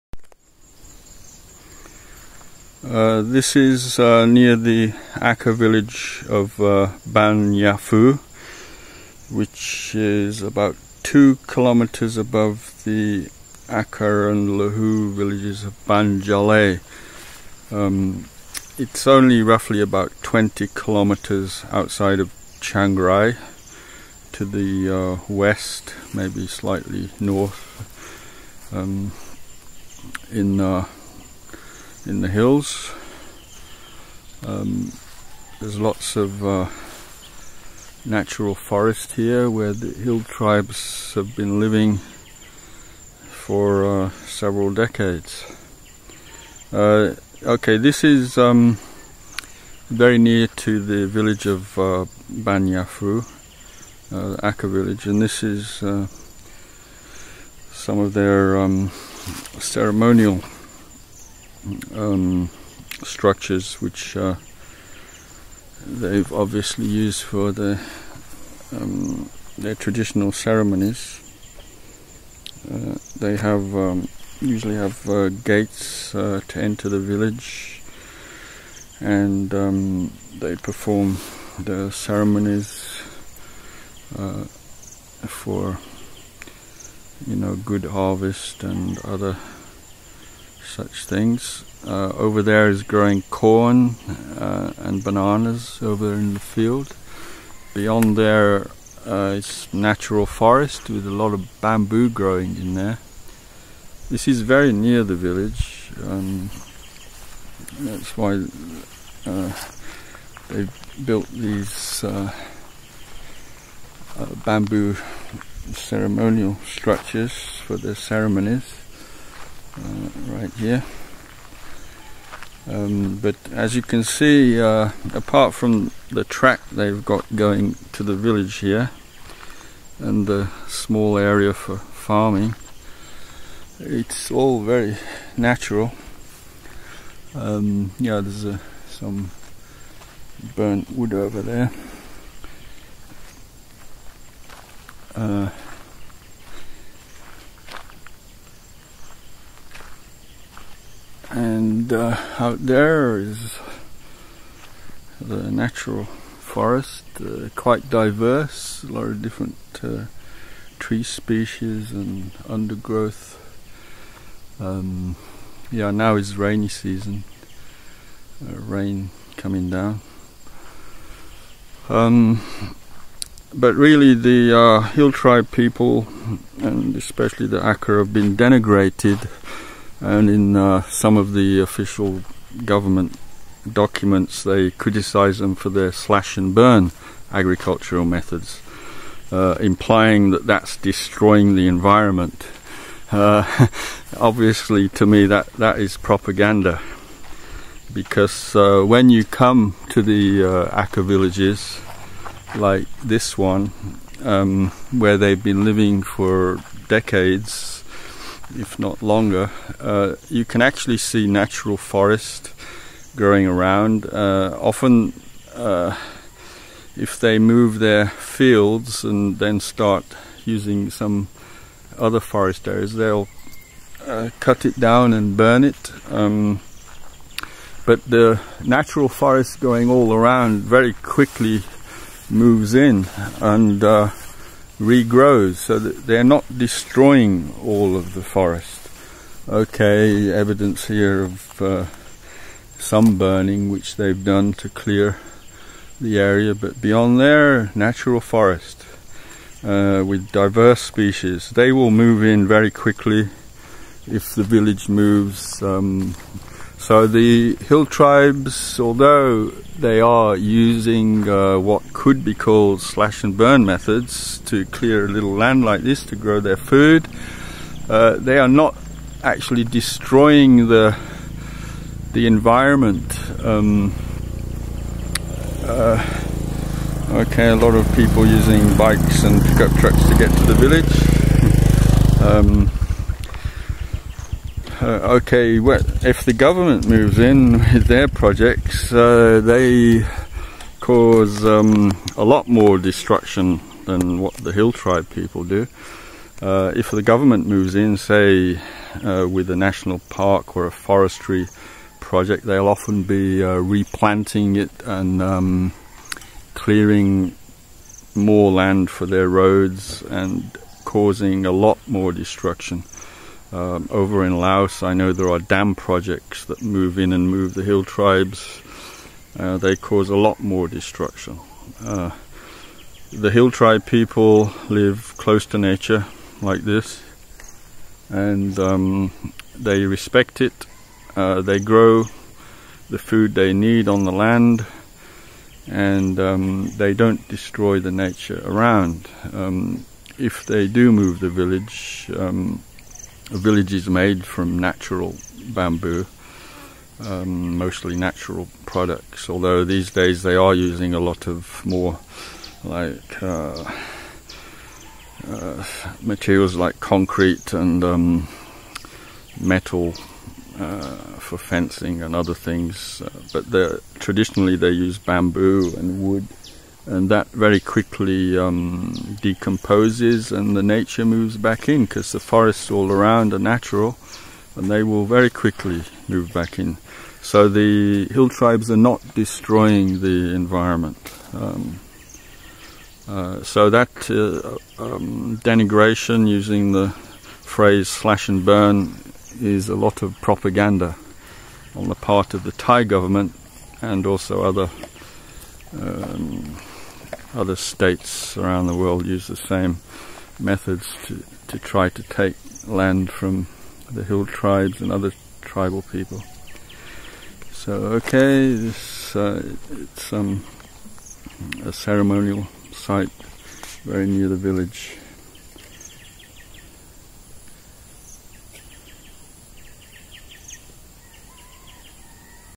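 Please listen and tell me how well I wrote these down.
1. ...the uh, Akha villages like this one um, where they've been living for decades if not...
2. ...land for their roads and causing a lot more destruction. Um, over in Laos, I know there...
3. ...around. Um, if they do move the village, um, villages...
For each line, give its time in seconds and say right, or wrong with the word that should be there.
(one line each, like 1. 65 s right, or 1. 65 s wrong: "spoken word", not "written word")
1. 200 s right
2. 308 s right
3. 338 s right.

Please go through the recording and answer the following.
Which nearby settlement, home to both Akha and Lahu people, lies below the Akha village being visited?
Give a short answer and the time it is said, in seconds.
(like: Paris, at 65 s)
Banjale, at 15 s.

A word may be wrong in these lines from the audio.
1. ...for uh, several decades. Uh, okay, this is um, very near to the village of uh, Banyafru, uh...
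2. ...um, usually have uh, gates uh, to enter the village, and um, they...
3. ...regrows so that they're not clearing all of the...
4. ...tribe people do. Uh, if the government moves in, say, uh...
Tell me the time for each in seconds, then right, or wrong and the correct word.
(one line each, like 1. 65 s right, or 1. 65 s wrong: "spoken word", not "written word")
1. 43 s right
2. 73 s right
3. 234 s wrong: "destroying", not "clearing"
4. 294 s right.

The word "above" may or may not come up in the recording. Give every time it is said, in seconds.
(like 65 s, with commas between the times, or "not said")
12 s.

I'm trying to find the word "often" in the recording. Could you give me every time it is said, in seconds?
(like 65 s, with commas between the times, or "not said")
214 s, 302 s.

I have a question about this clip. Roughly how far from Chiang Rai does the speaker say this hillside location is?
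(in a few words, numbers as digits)
20 kilometers.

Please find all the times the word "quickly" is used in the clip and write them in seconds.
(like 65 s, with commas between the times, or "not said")
230 s, 252 s, 367 s, 375 s.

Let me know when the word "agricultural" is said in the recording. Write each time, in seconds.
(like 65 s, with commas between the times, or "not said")
187 s.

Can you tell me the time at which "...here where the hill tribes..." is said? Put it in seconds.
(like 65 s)
39 s.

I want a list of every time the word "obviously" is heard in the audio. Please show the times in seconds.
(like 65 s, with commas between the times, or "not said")
66 s, 194 s.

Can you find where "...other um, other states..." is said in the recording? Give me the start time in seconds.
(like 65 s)
394 s.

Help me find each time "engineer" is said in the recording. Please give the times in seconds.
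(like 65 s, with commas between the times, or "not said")
not said.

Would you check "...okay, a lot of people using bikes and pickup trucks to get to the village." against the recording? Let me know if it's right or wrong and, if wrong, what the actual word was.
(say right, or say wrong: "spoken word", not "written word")
right.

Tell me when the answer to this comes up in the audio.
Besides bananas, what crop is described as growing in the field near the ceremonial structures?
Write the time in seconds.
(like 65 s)
93 s.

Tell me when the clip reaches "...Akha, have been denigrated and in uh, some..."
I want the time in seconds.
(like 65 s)
177 s.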